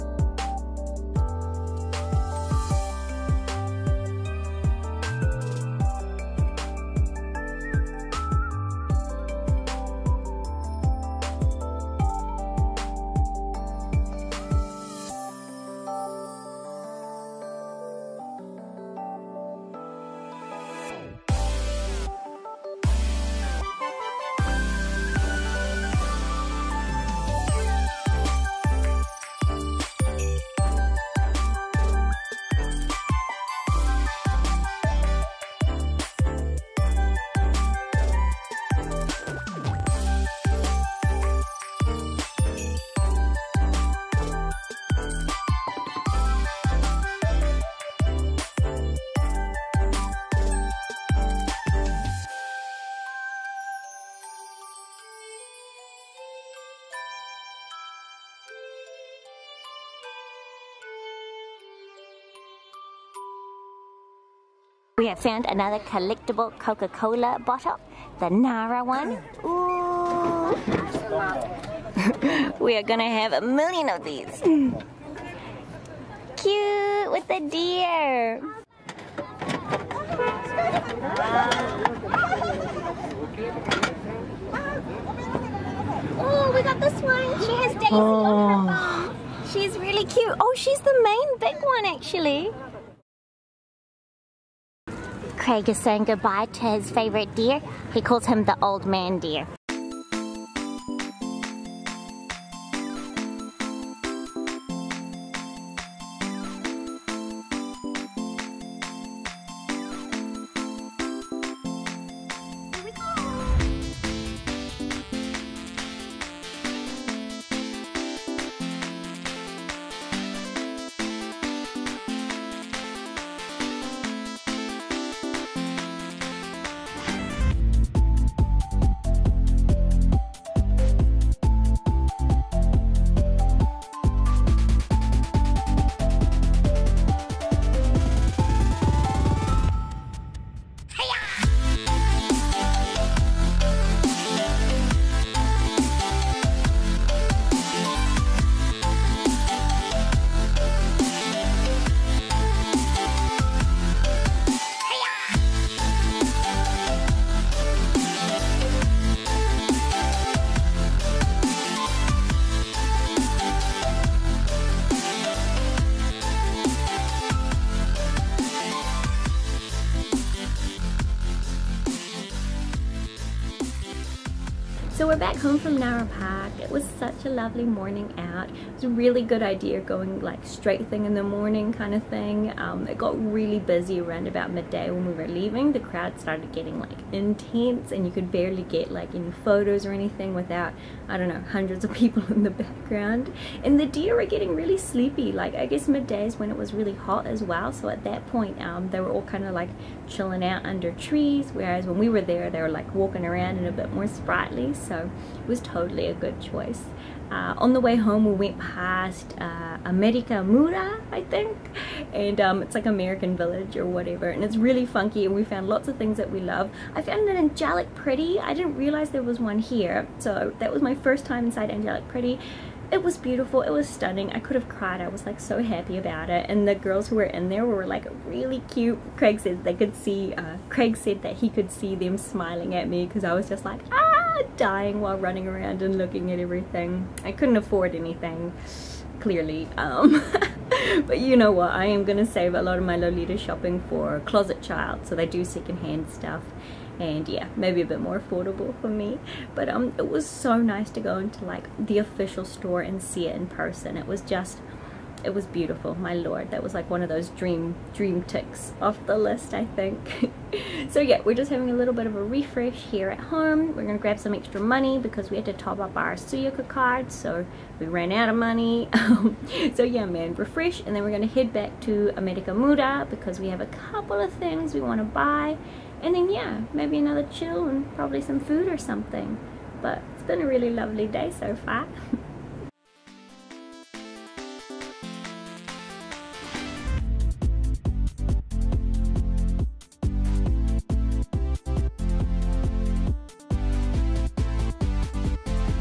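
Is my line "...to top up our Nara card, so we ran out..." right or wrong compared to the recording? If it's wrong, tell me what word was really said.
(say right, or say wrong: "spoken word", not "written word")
wrong: "Suica", not "Nara".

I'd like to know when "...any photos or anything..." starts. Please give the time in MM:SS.
03:09.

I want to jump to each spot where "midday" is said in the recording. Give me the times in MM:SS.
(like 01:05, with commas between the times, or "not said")
03:04, 03:15.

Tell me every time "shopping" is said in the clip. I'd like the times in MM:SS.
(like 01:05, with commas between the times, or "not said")
04:03.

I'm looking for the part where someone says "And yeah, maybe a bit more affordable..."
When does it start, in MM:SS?
04:06.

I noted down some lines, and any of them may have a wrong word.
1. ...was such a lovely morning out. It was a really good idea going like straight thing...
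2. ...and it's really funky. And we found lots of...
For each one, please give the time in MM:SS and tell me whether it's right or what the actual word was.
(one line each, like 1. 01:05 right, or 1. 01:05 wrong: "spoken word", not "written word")
1. 02:56 right
2. 03:34 right.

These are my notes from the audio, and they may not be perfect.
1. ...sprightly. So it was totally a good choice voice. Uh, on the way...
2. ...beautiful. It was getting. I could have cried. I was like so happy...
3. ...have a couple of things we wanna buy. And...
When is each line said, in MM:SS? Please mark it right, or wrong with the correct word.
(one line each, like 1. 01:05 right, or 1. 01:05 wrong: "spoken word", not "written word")
1. 03:24 right
2. 03:43 wrong: "stunning", not "getting"
3. 04:33 right.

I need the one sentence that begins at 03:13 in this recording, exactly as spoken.
And the deer were getting really sleepy.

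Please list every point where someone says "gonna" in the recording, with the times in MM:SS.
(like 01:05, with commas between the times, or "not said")
01:12, 04:23, 04:31.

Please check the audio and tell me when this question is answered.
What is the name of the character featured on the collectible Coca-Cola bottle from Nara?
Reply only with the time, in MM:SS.
01:27.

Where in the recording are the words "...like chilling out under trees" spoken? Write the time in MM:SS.
03:19.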